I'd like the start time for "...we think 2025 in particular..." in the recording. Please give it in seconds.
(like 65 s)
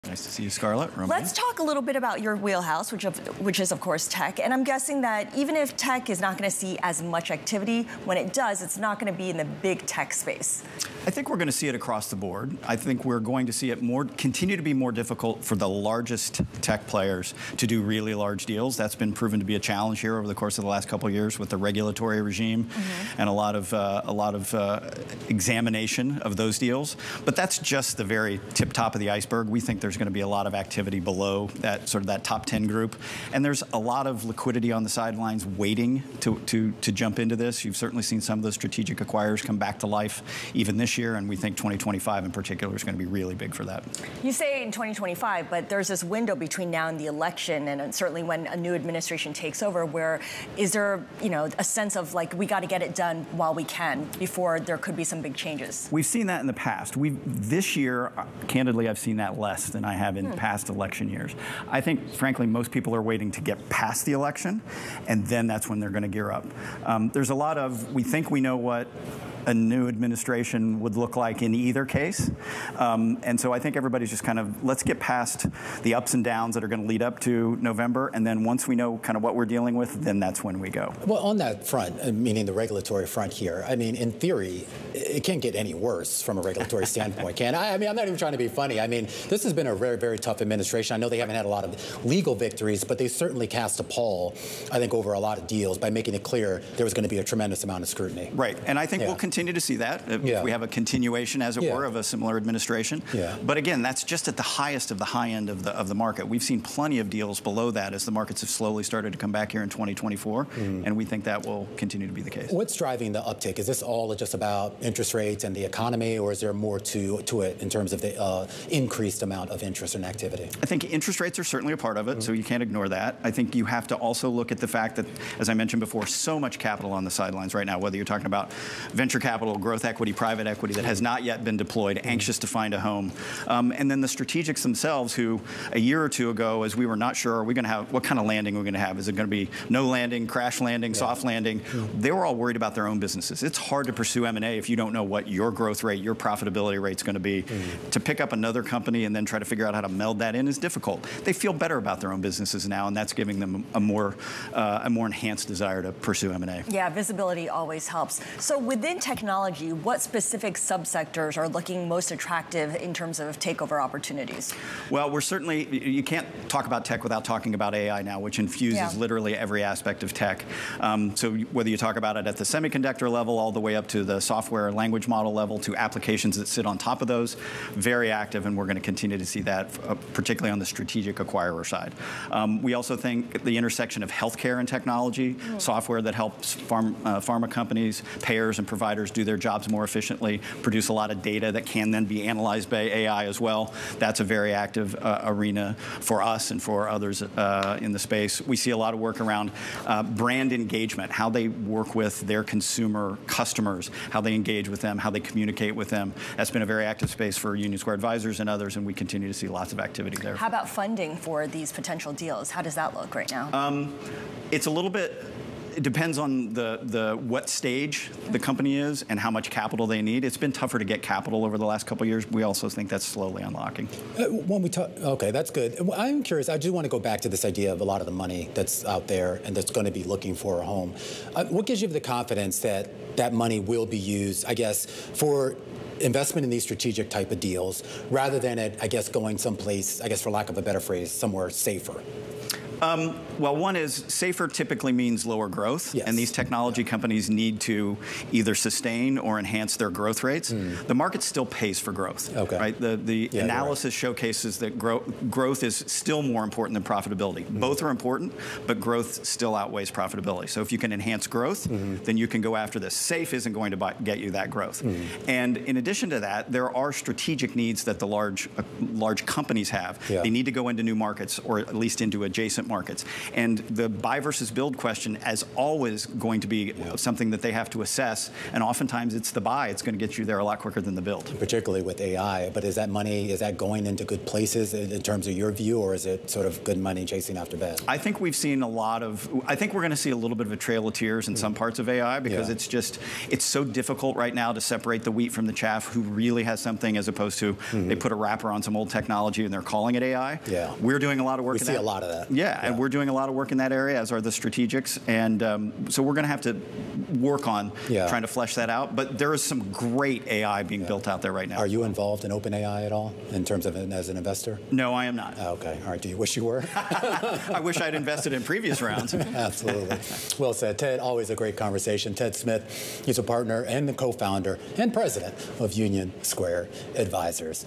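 41 s.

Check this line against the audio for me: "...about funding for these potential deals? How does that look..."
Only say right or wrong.
right.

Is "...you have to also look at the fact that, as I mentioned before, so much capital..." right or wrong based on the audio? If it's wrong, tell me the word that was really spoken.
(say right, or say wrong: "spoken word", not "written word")
right.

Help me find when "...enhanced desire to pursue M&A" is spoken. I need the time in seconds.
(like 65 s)
155 s.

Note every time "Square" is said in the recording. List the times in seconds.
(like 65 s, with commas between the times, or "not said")
207 s, 326 s.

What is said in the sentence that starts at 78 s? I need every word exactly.
And then once we know kind of what we're dealing with, then that's when we go.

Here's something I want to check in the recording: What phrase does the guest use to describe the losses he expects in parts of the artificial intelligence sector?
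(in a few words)
trail of tears.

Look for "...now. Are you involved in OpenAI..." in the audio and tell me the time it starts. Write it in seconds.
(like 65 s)
311 s.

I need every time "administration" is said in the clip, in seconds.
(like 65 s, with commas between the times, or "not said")
48 s, 69 s, 90 s, 102 s.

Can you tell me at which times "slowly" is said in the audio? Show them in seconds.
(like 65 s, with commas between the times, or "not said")
108 s, 223 s.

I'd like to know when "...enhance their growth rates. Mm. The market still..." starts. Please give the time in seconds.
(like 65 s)
249 s.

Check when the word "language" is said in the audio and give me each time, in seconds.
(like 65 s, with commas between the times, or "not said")
174 s.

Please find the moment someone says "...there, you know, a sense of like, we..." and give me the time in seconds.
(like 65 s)
50 s.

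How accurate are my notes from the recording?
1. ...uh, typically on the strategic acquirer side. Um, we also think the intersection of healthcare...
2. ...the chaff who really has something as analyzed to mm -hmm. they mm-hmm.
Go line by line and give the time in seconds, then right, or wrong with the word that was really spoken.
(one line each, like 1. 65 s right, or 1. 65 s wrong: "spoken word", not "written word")
1. 179 s wrong: "particularly", not "typically"
2. 295 s wrong: "opposed", not "analyzed".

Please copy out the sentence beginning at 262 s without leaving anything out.
then you can go after this.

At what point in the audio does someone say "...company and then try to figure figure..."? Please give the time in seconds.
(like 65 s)
148 s.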